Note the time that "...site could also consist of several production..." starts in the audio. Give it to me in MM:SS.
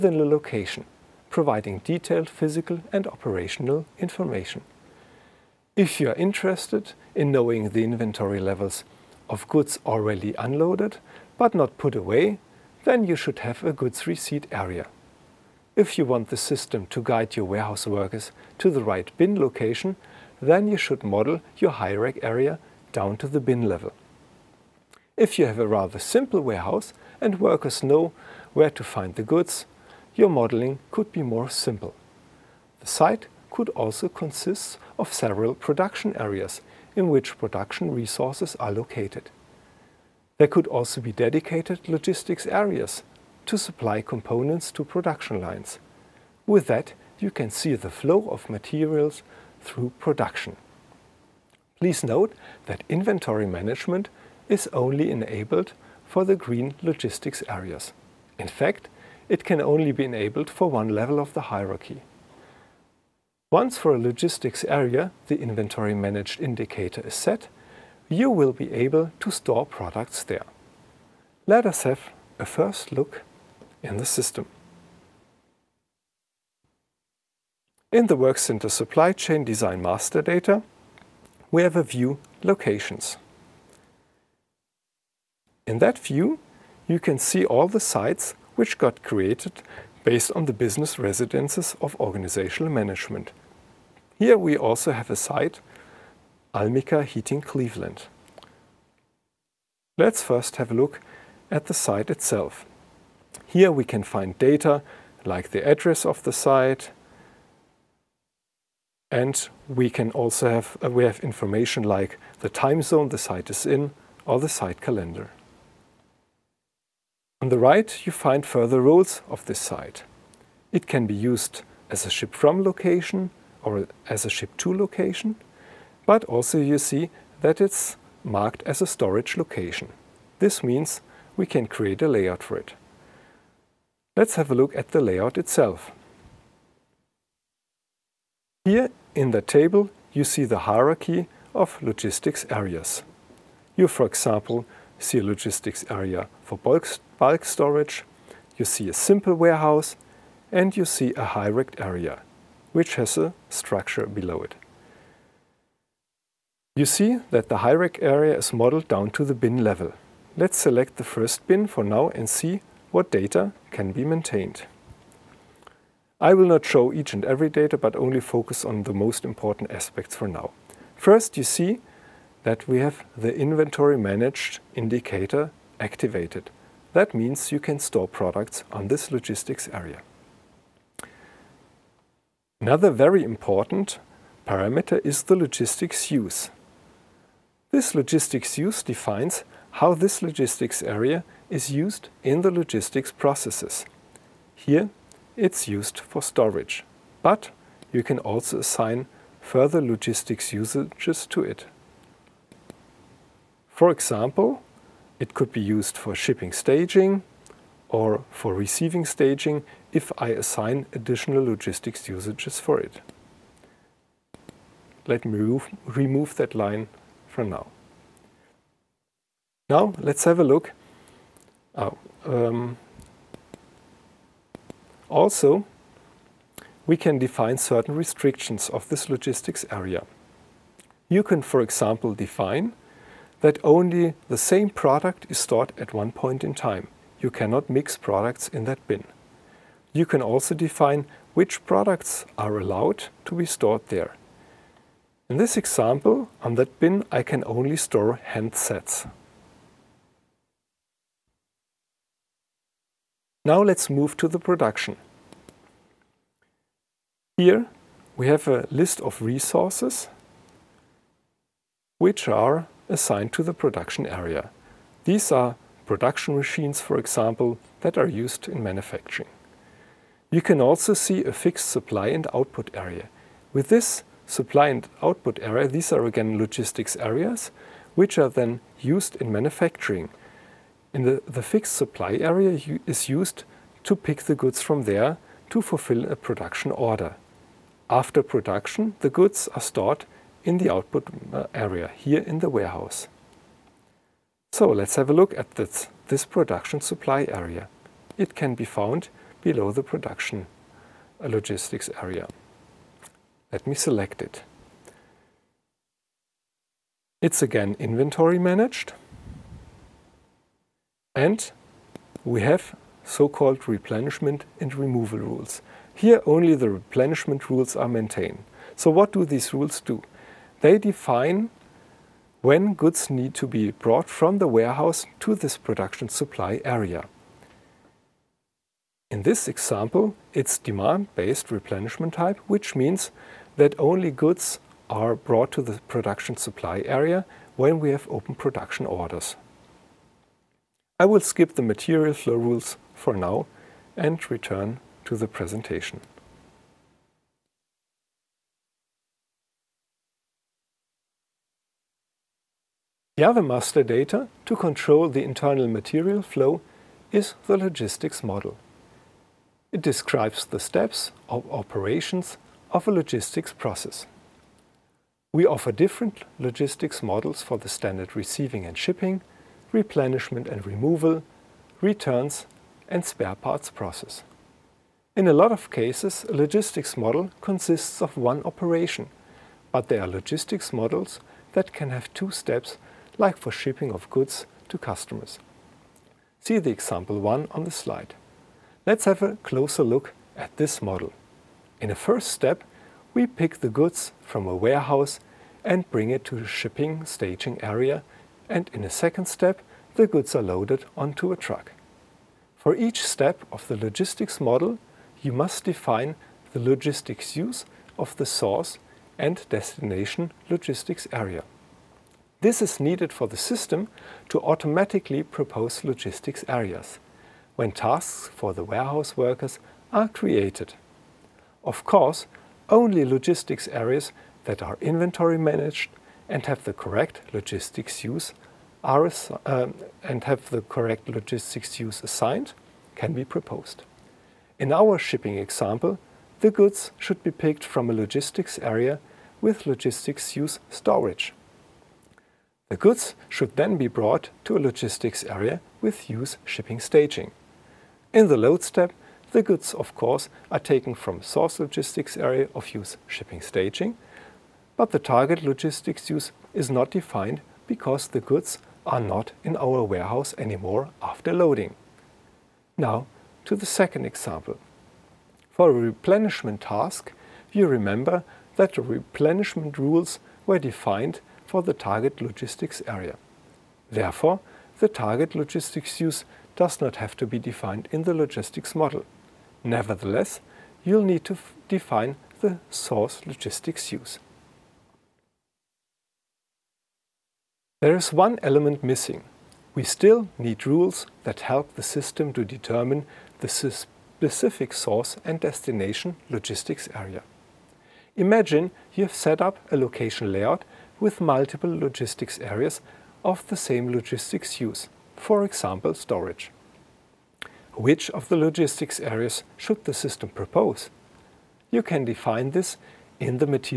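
00:32.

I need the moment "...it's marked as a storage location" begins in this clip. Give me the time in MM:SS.
02:07.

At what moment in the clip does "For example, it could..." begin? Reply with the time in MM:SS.
03:23.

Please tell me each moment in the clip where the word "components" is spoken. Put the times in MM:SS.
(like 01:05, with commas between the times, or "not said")
00:44.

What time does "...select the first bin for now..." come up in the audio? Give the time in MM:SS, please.
02:40.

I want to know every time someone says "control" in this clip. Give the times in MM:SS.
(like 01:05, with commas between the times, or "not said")
05:54.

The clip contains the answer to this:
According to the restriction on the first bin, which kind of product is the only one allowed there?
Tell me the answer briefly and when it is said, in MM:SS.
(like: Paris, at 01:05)
Handsets, at 04:08.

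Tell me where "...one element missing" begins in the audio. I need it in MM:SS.
08:08.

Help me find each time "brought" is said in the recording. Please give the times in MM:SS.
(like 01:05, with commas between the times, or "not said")
05:23, 05:35, 07:23.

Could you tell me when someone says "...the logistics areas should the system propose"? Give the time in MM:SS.
08:28.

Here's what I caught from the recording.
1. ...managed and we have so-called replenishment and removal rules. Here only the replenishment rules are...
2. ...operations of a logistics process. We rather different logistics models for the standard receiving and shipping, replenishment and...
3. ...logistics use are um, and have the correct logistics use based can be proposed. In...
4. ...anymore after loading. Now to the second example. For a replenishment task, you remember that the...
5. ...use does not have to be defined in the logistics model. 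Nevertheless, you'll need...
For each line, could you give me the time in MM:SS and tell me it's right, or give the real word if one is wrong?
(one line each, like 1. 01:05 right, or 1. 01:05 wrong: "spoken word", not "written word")
1. 05:08 right
2. 06:01 wrong: "offer", not "rather"
3. 07:07 wrong: "assigned", not "based"
4. 07:40 right
5. 07:56 right.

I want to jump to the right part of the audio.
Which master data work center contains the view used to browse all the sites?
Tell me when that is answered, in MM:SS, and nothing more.
01:18.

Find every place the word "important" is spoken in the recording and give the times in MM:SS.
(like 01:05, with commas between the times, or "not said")
02:49, 03:03.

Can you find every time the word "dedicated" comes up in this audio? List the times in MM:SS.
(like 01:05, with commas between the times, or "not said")
00:41.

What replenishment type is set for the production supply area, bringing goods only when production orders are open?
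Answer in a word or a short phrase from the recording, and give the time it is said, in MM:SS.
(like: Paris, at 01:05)
Demand-based, at 05:30.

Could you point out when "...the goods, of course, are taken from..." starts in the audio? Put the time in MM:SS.
07:29.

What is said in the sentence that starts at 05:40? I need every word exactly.
I will skip the material flow rules for now and return to the presentation.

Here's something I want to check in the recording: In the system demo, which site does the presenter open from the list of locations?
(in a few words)
Almica Heating Cleveland.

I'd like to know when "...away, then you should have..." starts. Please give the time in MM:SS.
00:11.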